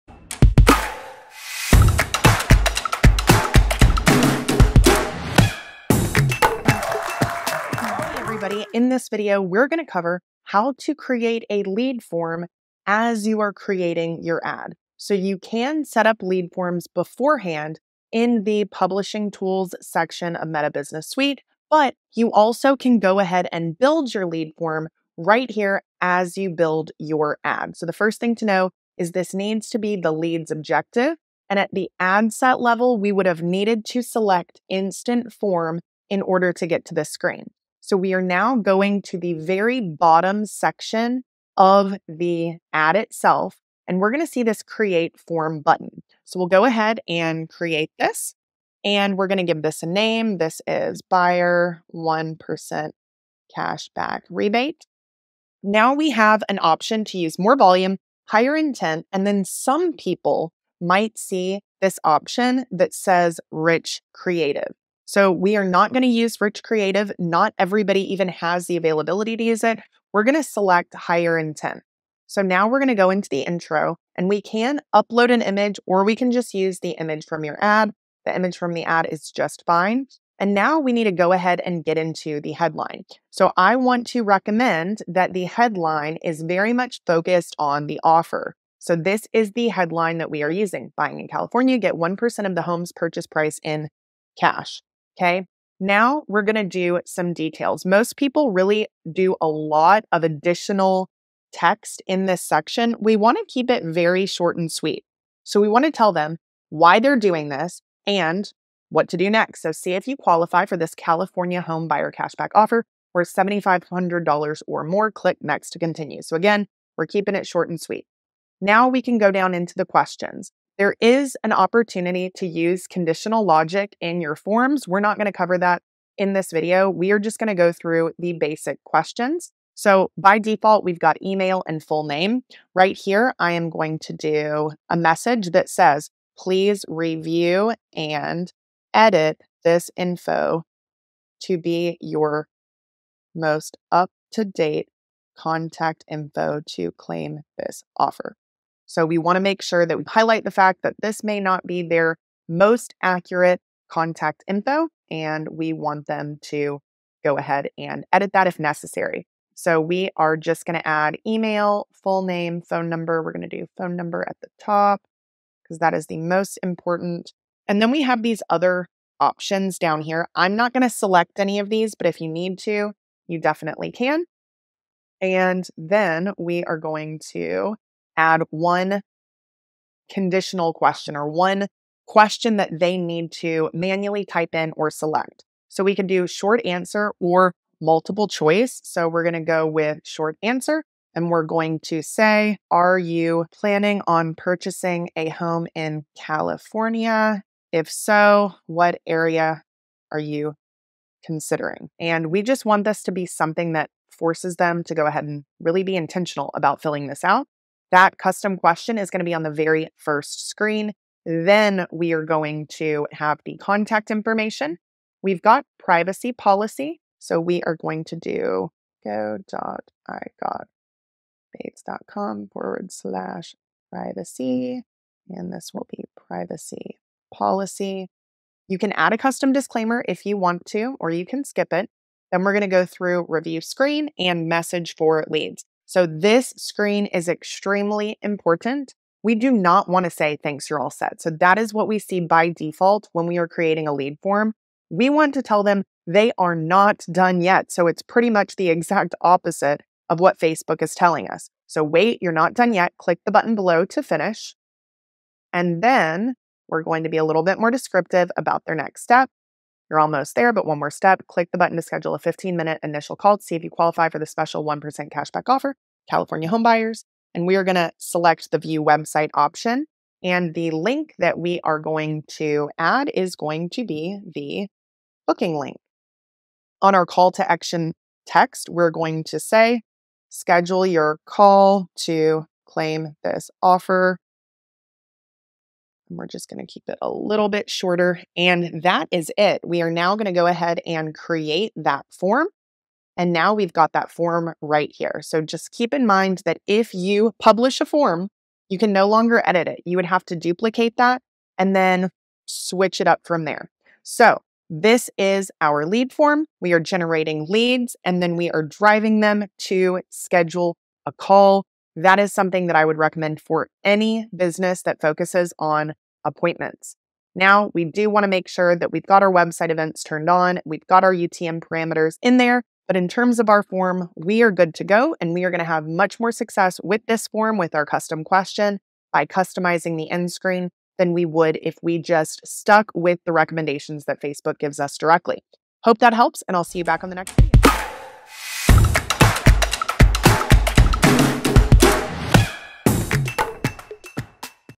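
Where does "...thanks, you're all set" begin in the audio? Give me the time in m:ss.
4:00.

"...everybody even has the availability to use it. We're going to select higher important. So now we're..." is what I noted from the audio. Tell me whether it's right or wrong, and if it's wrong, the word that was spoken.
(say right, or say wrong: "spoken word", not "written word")
wrong: "intent", not "important".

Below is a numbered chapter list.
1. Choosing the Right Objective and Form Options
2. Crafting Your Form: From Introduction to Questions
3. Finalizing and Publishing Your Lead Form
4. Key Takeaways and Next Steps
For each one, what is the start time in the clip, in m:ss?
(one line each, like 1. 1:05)
1. 0:19
2. 1:04
3. 4:41
4. 4:58.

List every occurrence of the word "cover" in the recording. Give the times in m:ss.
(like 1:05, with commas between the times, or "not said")
0:09, 2:05.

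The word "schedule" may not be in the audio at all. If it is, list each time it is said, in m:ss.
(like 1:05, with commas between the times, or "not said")
4:21, 4:40, 5:10.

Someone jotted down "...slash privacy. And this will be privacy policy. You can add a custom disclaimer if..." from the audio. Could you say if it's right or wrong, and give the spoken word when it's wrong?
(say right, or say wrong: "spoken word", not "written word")
right.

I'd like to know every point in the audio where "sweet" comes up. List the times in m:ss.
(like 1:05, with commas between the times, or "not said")
1:44, 1:57.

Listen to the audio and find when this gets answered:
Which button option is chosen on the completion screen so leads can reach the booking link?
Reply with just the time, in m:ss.
4:28.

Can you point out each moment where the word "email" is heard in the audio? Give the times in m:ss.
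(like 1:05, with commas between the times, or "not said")
2:11, 2:41.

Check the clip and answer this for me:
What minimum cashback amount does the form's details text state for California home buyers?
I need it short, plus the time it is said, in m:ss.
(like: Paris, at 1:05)
$7,500, at 1:53.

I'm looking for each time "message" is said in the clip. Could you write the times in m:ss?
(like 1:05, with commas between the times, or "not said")
2:14, 3:54.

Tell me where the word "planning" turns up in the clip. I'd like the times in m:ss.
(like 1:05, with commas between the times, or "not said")
3:13.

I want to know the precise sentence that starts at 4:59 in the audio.
You would have to duplicate that and then switch it up from there.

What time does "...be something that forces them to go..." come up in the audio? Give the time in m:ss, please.
3:23.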